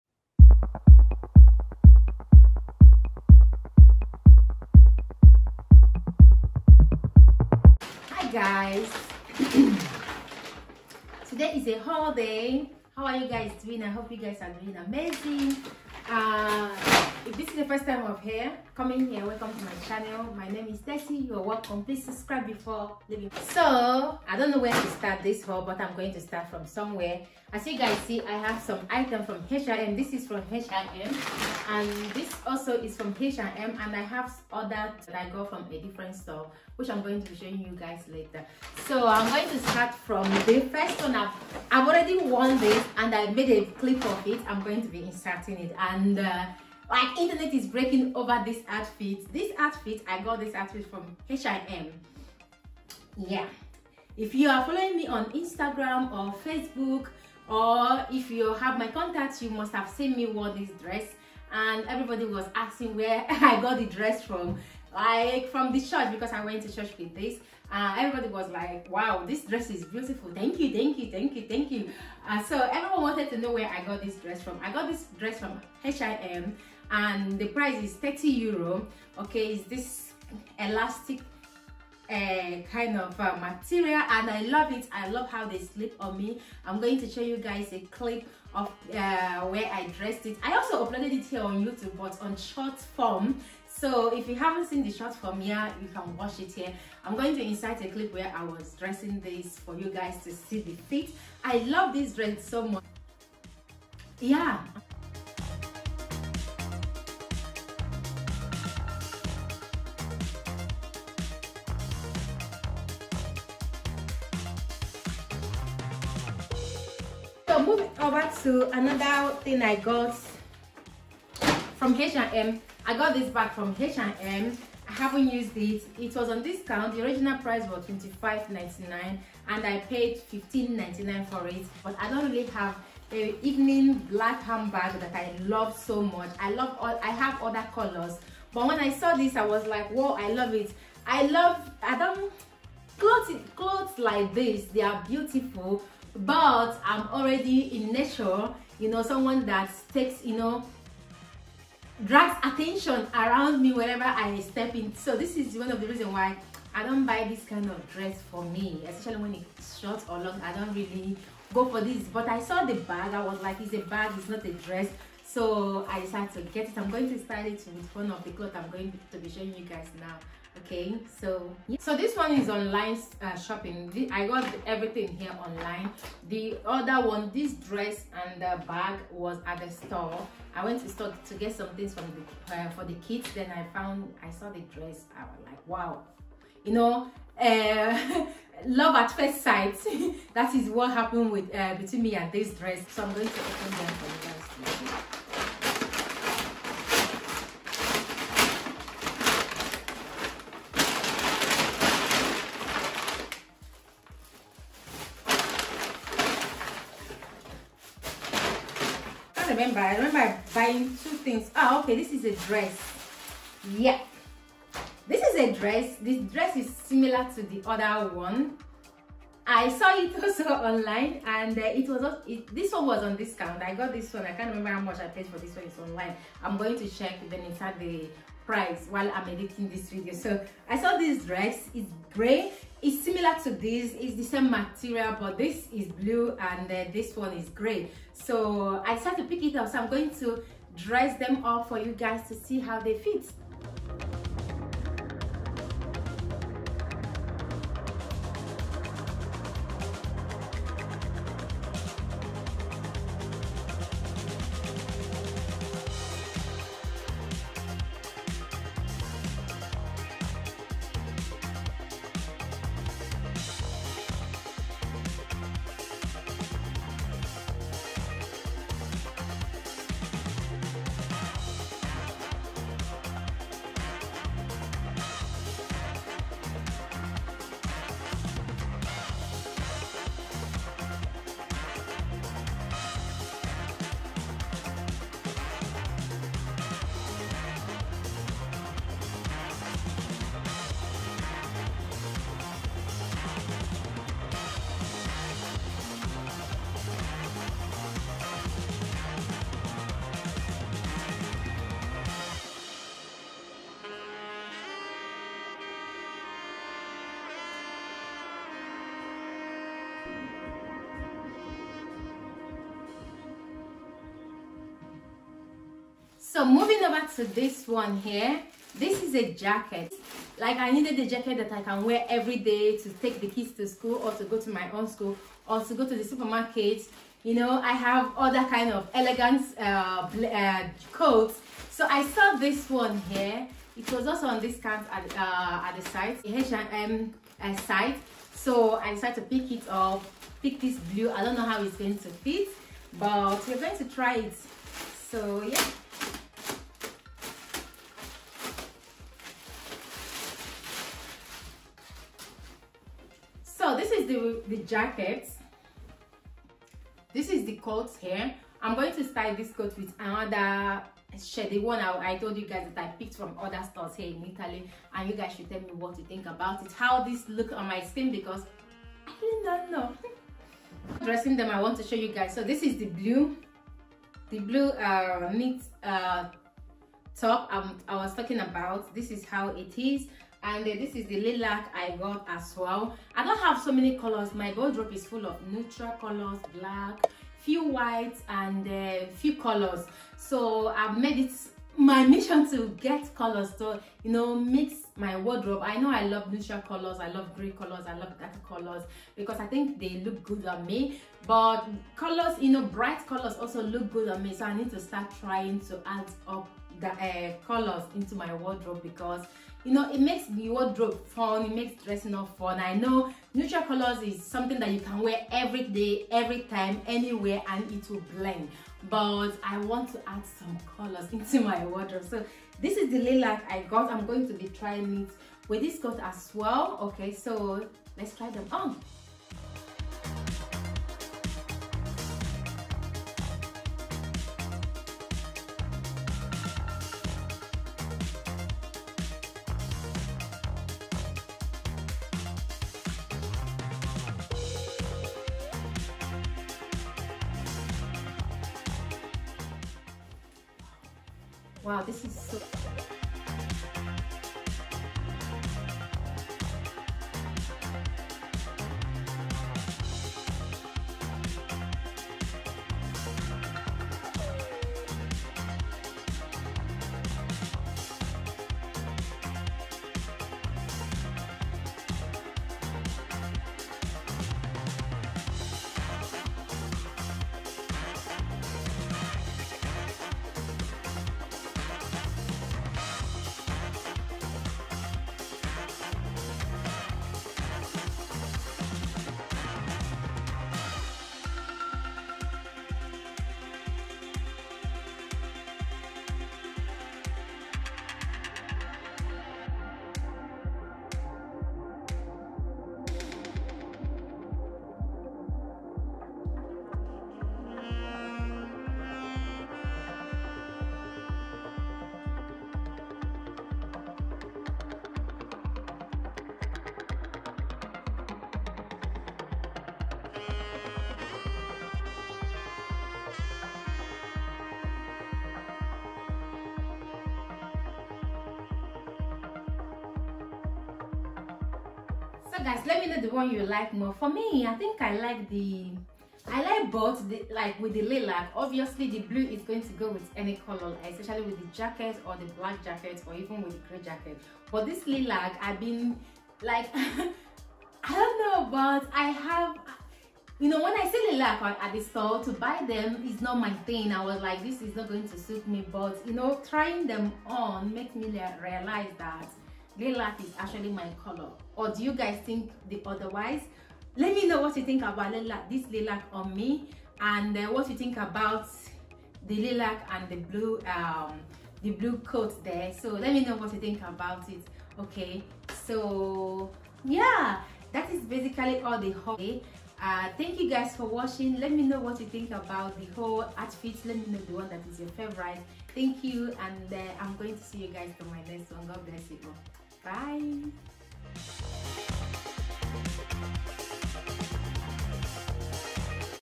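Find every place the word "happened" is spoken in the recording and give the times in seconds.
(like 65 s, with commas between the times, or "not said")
190 s.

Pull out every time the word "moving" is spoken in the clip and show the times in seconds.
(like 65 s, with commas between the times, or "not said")
117 s, 316 s.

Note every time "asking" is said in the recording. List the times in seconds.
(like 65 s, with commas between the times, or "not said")
62 s.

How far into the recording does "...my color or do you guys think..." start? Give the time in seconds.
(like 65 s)
560 s.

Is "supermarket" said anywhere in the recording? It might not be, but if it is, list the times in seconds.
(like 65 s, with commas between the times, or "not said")
326 s.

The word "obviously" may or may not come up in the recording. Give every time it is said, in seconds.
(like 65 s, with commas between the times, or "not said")
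538 s.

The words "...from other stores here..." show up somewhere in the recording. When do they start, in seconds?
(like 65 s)
363 s.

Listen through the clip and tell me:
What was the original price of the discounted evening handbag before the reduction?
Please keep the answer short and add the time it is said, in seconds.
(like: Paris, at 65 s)
$25.99, at 127 s.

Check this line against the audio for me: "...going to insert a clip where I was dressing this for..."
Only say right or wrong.
right.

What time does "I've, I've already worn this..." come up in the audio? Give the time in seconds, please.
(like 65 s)
41 s.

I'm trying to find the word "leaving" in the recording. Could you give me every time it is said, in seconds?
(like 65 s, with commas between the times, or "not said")
23 s.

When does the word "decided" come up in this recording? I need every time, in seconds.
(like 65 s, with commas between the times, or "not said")
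165 s, 238 s, 338 s.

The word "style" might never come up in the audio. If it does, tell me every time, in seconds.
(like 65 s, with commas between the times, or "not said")
167 s, 359 s.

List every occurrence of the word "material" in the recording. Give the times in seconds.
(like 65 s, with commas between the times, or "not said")
83 s, 234 s.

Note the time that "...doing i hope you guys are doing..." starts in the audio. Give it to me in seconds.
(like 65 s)
13 s.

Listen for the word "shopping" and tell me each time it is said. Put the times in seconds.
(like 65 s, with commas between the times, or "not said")
173 s.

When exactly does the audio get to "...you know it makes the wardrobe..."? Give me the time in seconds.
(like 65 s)
409 s.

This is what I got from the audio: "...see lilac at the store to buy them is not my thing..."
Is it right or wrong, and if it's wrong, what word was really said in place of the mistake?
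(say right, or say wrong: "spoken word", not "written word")
right.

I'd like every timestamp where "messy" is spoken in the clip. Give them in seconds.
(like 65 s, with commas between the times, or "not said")
not said.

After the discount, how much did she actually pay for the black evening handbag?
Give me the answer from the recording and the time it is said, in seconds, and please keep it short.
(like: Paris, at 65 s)
$15.99, at 130 s.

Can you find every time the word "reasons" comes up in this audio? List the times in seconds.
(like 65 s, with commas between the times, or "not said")
155 s.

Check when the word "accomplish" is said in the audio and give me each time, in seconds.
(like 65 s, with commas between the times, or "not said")
not said.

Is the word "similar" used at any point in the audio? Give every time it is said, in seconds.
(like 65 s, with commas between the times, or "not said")
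216 s, 233 s.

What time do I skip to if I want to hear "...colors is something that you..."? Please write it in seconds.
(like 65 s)
413 s.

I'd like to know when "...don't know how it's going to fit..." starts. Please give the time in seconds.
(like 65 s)
341 s.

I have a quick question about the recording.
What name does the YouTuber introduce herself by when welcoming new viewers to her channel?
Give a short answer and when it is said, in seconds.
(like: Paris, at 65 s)
Tessy, at 20 s.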